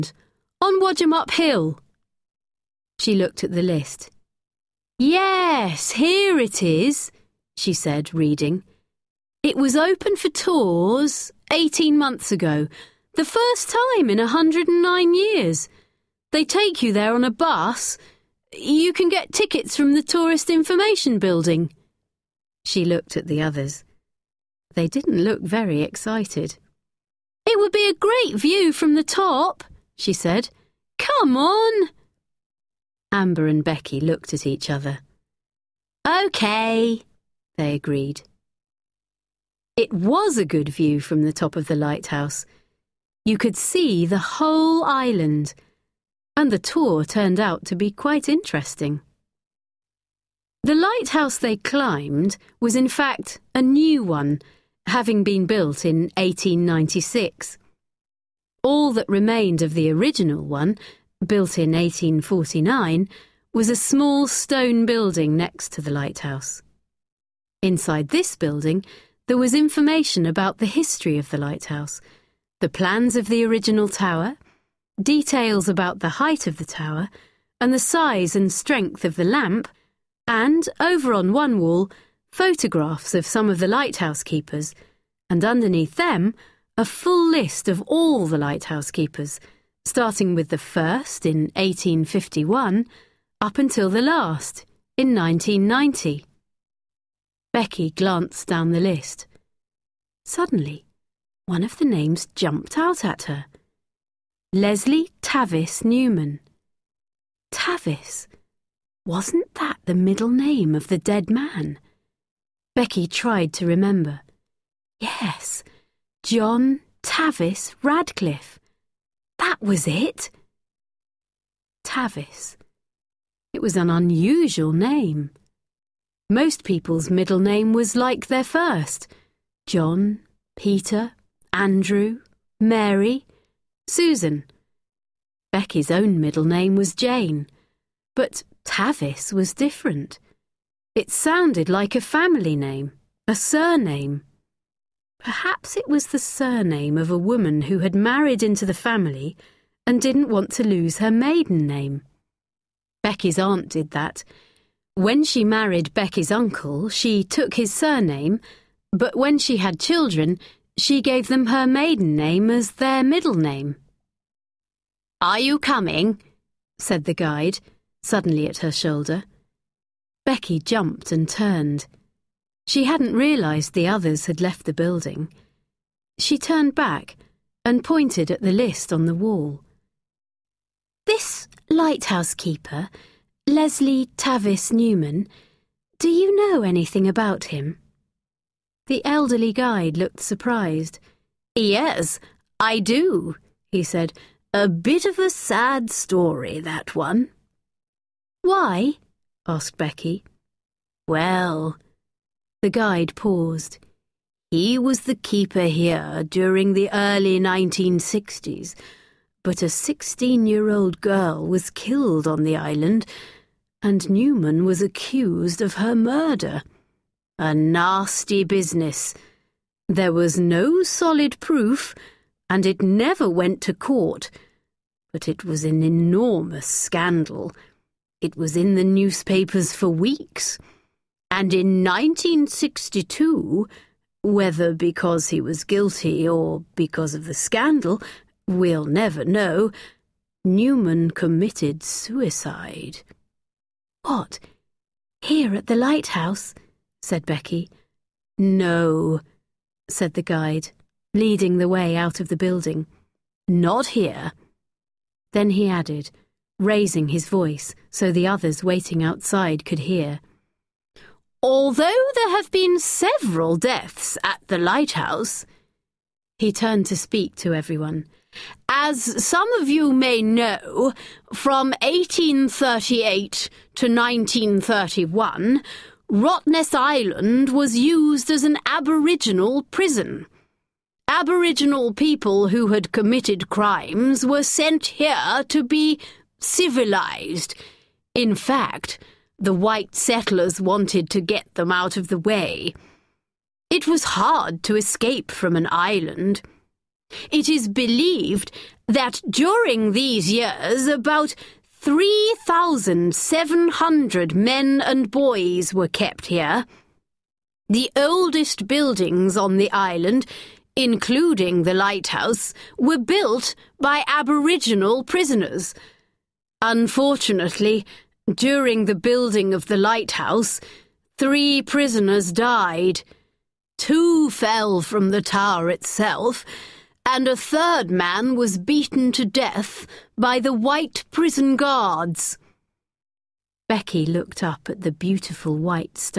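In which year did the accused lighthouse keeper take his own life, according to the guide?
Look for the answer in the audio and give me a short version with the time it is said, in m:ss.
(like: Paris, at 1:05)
1962, at 3:51.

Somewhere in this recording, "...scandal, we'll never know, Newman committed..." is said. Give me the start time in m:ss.
3:57.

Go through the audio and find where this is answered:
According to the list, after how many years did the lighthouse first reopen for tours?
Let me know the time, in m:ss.
0:14.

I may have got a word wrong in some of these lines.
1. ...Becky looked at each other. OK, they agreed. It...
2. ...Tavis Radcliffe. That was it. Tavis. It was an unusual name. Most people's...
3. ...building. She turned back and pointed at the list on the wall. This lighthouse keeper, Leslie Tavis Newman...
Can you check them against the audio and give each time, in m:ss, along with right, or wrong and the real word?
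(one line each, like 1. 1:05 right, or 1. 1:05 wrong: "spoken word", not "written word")
1. 0:33 right
2. 1:57 right
3. 2:54 right.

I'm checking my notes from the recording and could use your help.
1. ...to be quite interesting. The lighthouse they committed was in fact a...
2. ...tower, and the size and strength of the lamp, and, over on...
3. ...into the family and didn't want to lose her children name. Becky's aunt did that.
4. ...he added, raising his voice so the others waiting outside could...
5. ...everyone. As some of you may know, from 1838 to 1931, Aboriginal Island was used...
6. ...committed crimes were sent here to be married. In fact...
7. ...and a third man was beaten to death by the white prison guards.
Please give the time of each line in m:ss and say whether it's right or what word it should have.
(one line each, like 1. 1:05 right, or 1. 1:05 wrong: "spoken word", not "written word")
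1. 0:47 wrong: "climbed", not "committed"
2. 1:16 right
3. 2:28 wrong: "maiden", not "children"
4. 4:15 right
5. 4:27 wrong: "Rottnest", not "Aboriginal"
6. 4:42 wrong: "civilized", not "married"
7. 5:27 right.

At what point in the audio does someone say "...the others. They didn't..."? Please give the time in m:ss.
0:23.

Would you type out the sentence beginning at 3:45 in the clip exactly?
But it was an enormous scandal.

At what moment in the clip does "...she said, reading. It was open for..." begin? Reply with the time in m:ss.
0:07.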